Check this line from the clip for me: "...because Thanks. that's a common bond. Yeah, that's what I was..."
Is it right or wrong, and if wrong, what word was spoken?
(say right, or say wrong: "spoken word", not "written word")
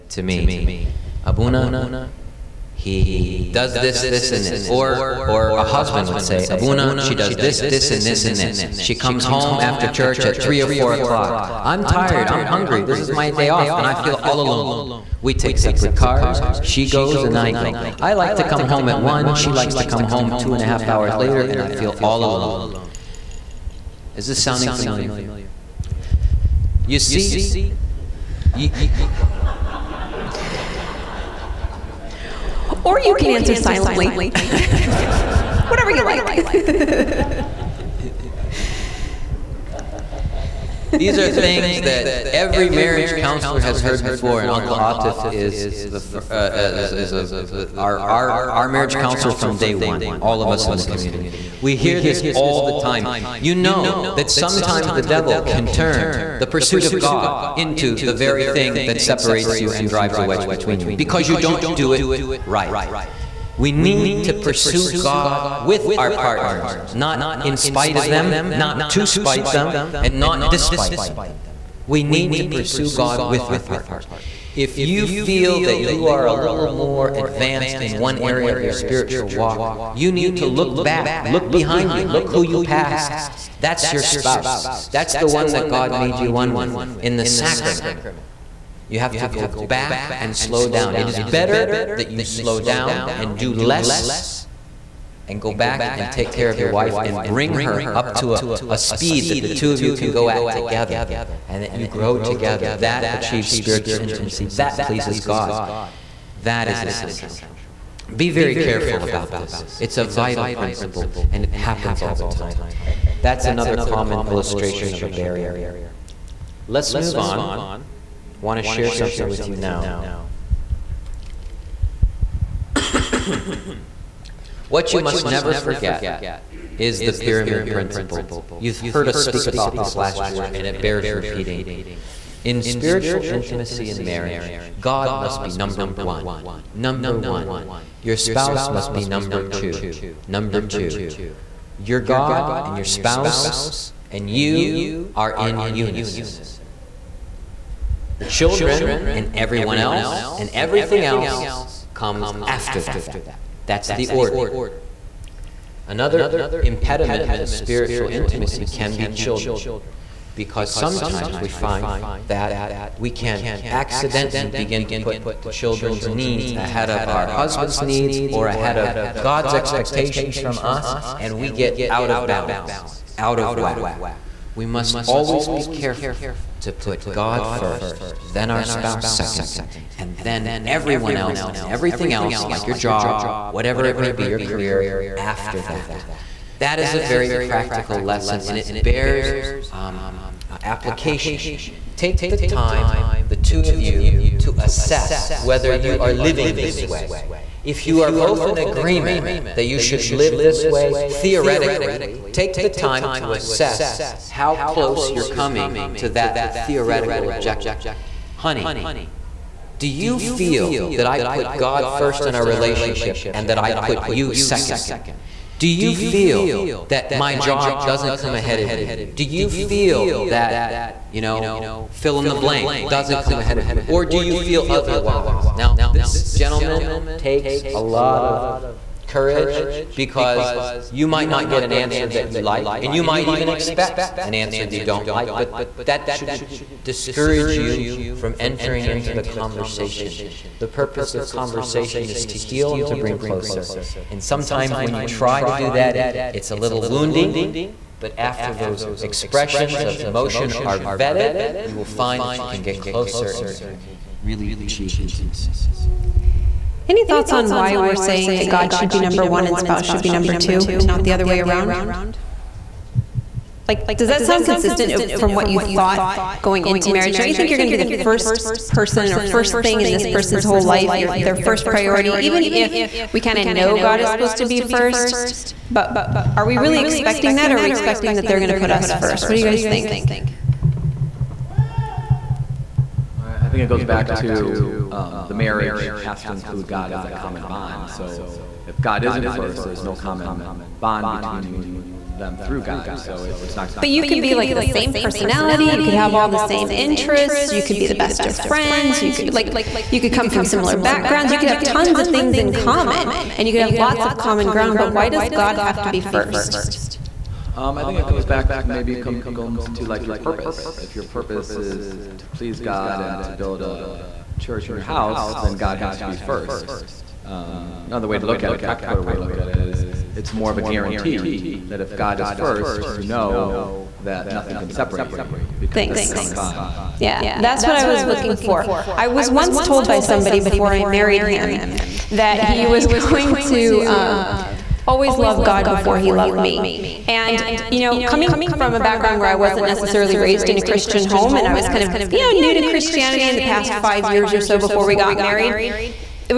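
right.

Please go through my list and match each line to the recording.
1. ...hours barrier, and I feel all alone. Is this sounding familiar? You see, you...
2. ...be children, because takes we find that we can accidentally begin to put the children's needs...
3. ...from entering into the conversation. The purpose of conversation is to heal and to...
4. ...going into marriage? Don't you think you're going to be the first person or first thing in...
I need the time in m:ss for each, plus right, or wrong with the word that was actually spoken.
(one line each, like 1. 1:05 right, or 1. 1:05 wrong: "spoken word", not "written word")
1. 0:20 wrong: "later", not "barrier"
2. 2:38 wrong: "sometimes", not "takes"
3. 3:58 right
4. 4:26 right.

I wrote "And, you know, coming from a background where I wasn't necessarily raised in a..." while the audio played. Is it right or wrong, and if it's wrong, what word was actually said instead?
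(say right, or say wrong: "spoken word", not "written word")
right.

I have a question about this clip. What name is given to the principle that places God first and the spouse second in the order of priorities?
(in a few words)
pyramid principle.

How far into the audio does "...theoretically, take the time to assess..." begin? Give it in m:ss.
3:20.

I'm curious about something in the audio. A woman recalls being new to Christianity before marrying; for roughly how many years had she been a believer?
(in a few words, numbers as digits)
5 years.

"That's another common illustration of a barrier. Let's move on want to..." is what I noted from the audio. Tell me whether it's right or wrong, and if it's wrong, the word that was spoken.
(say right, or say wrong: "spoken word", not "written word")
right.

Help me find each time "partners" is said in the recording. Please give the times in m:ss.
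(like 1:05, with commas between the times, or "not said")
1:06, 1:13.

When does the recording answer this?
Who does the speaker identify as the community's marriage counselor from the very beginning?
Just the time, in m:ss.
0:44.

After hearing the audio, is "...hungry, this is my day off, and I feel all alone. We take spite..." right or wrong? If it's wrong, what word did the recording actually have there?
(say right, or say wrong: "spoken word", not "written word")
wrong: "separate", not "spite".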